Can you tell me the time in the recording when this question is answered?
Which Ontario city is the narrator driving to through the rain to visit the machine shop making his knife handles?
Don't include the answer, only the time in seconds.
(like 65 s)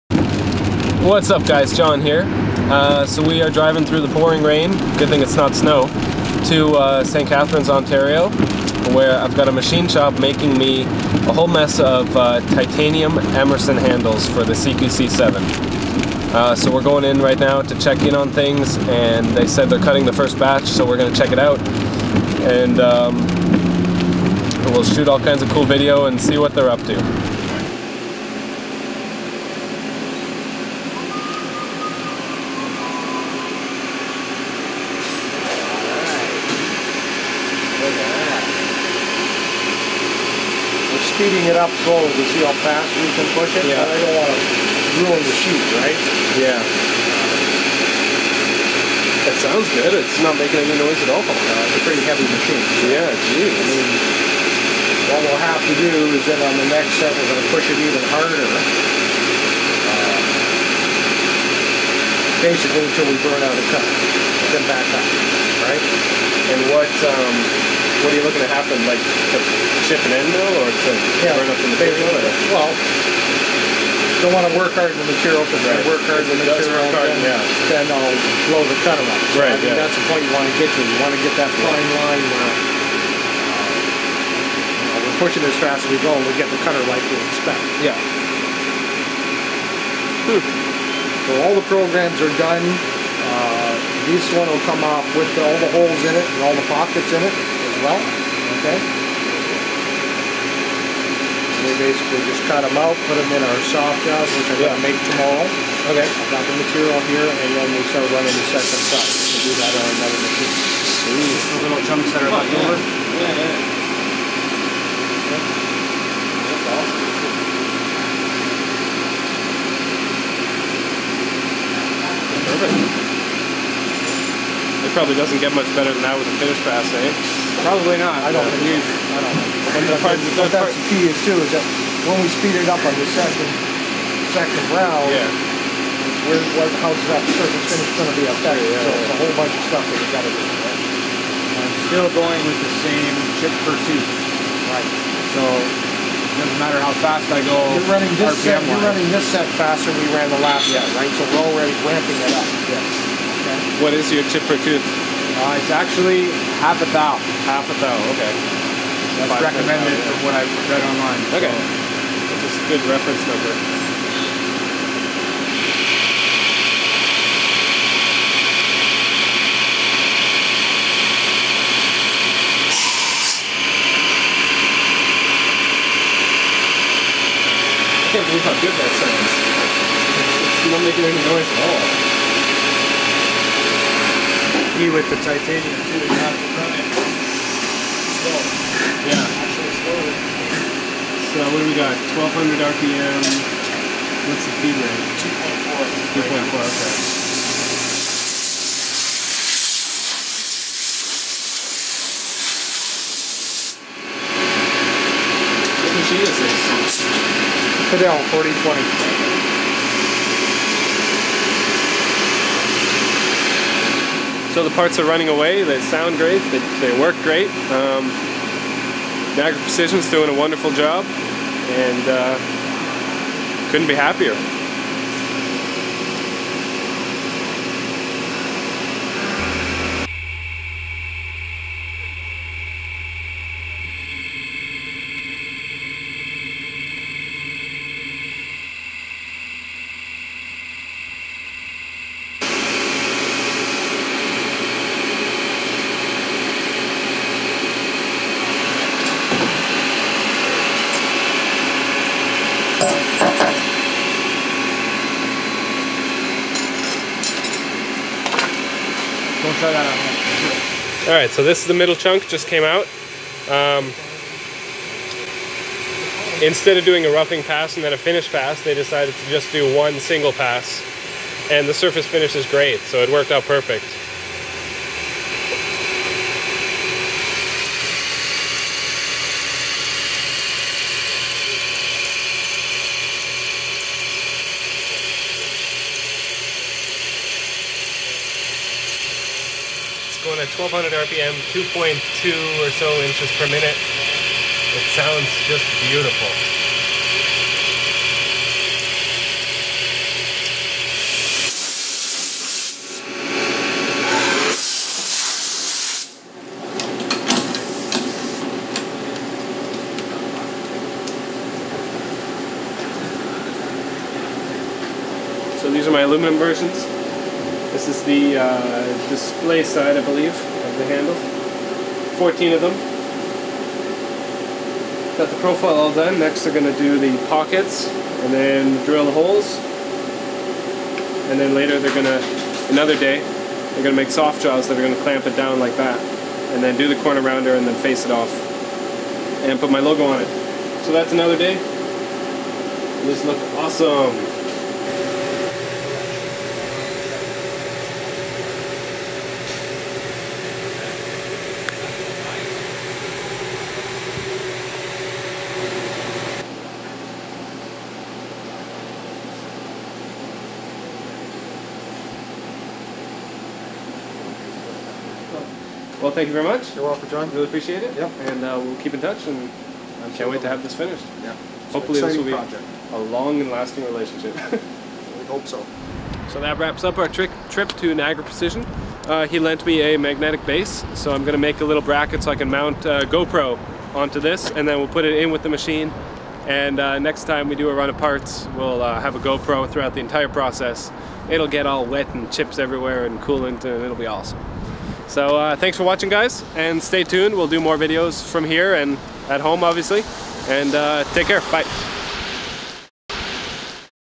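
7 s.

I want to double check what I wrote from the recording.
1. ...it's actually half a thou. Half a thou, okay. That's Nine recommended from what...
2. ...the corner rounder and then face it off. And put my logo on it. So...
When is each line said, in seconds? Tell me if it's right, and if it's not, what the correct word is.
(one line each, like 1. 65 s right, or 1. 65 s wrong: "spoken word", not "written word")
1. 155 s wrong: "Five", not "Nine"
2. 336 s right.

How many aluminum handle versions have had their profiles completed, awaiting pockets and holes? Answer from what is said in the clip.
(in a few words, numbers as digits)
14.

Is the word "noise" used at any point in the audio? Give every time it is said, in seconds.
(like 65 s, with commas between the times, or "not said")
50 s, 181 s.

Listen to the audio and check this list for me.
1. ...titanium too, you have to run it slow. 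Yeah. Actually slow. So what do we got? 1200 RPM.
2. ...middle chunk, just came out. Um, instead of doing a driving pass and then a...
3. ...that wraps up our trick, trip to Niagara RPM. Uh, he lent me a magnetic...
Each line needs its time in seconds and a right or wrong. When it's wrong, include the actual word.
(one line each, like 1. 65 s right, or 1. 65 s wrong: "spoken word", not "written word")
1. 185 s right
2. 261 s wrong: "roughing", not "driving"
3. 376 s wrong: "Precision", not "RPM".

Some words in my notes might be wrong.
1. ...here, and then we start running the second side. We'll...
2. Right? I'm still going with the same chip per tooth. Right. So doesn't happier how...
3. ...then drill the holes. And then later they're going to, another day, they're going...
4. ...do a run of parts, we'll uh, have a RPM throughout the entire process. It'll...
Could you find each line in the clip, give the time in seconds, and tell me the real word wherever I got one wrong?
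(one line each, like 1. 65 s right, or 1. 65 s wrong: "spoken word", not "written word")
1. 107 s right
2. 140 s wrong: "matter", not "happier"
3. 328 s right
4. 387 s wrong: "GoPro", not "RPM".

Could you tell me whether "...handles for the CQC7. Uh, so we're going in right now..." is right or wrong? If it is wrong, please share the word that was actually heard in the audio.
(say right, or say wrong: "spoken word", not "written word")
right.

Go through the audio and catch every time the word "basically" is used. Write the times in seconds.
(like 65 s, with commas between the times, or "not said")
62 s, 101 s.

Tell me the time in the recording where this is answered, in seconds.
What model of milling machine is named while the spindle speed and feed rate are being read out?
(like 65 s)
207 s.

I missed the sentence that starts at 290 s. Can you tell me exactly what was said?
at 1200 RPM, 2.2 or so inches per minute.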